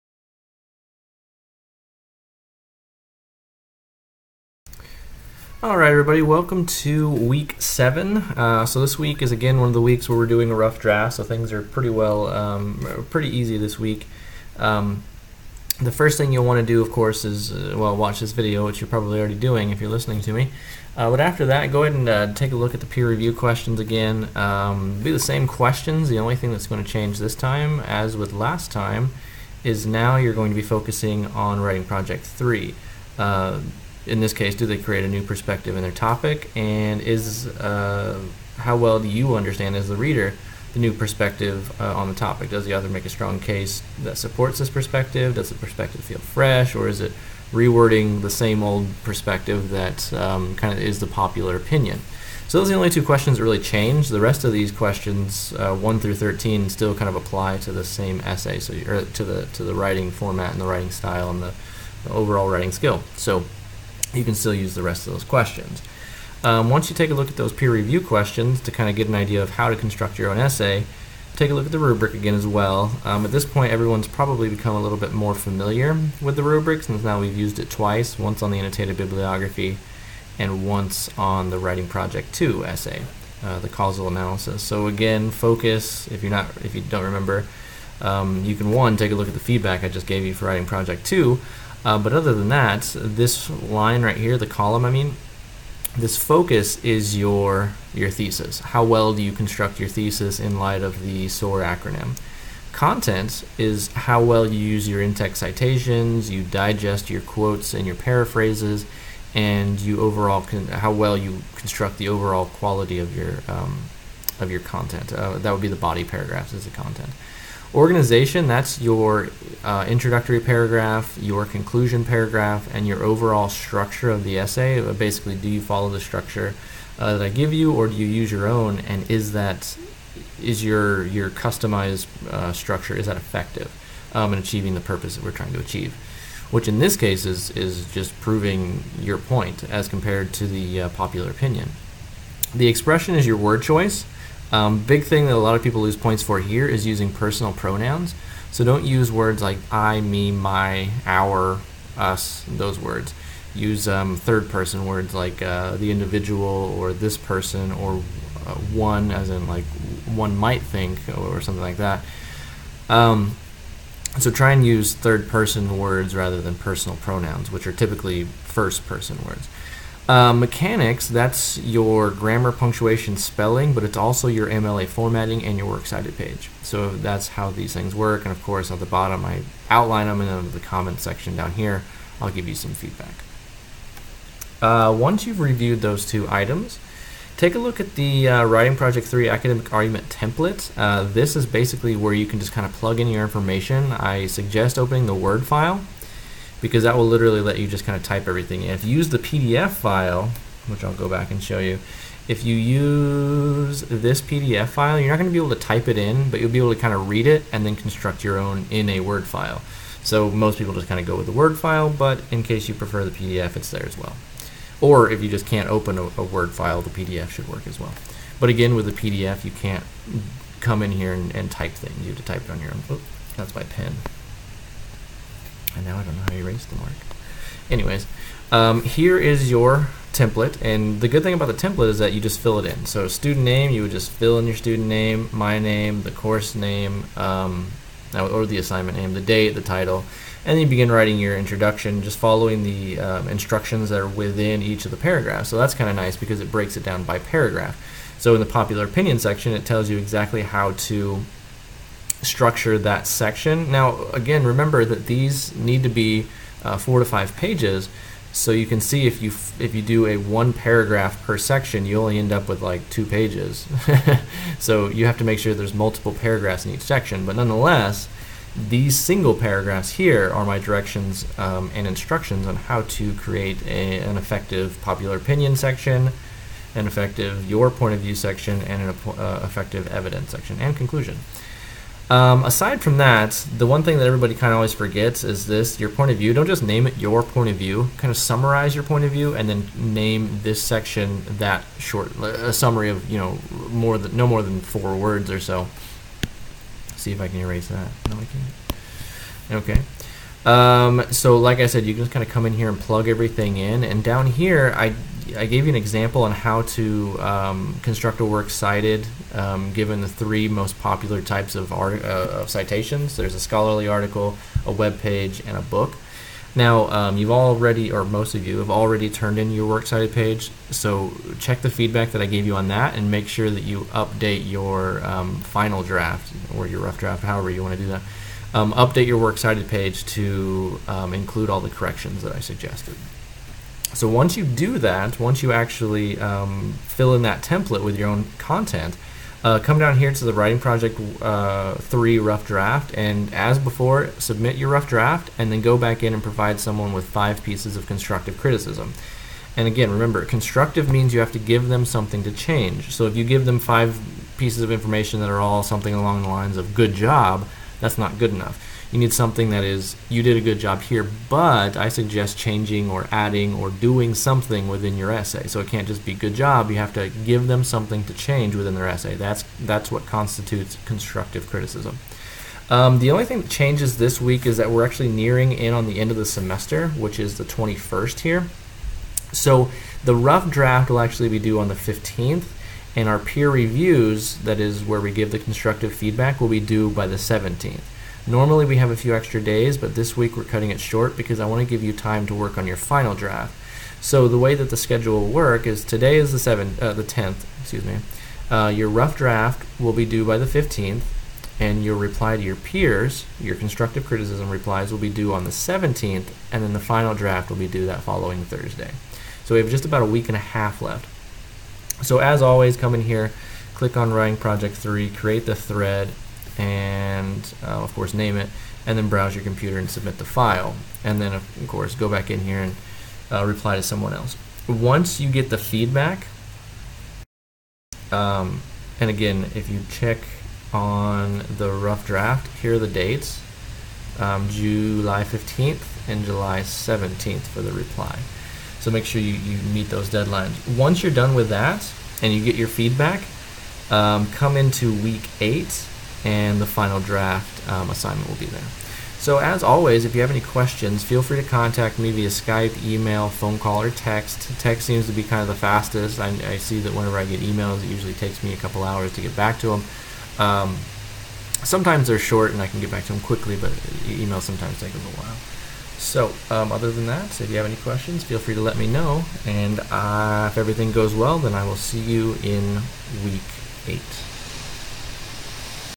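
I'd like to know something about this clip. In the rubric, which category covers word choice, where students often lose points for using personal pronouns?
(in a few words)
Expression.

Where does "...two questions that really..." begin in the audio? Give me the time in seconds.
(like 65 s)
52 s.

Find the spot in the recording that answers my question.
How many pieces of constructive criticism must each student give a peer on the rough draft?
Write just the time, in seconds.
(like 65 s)
347 s.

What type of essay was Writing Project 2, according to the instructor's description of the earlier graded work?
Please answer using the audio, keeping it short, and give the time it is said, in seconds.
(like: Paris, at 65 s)
Causal analysis, at 83 s.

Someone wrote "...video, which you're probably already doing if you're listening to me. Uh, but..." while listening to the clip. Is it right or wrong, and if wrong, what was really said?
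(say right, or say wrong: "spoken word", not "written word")
right.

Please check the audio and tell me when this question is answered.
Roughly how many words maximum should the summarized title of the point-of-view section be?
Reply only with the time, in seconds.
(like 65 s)
294 s.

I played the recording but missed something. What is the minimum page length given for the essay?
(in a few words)
4 pages.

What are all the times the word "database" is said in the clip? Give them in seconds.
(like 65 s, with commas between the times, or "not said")
not said.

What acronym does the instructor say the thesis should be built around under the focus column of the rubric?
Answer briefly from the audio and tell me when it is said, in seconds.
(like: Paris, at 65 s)
SOAR, at 101 s.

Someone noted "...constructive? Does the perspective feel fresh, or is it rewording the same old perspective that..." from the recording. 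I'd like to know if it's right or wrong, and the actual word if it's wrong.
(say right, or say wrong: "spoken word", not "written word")
wrong: "perspective", not "constructive".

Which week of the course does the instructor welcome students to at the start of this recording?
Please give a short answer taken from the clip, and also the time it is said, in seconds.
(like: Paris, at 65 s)
Week 7, at 7 s.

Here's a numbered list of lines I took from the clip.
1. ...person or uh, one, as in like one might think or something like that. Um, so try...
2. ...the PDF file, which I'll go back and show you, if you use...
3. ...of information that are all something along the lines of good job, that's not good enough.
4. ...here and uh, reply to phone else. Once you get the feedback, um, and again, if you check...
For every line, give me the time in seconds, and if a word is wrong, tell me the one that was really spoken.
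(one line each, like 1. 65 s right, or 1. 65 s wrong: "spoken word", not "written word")
1. 157 s right
2. 199 s right
3. 354 s right
4. 422 s wrong: "someone", not "phone".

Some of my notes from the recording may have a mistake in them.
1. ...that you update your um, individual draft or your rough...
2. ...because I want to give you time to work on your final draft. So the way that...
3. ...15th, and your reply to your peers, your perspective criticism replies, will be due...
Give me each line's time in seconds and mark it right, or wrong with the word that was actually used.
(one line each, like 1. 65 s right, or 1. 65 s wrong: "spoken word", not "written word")
1. 323 s wrong: "final", not "individual"
2. 391 s right
3. 400 s wrong: "constructive", not "perspective".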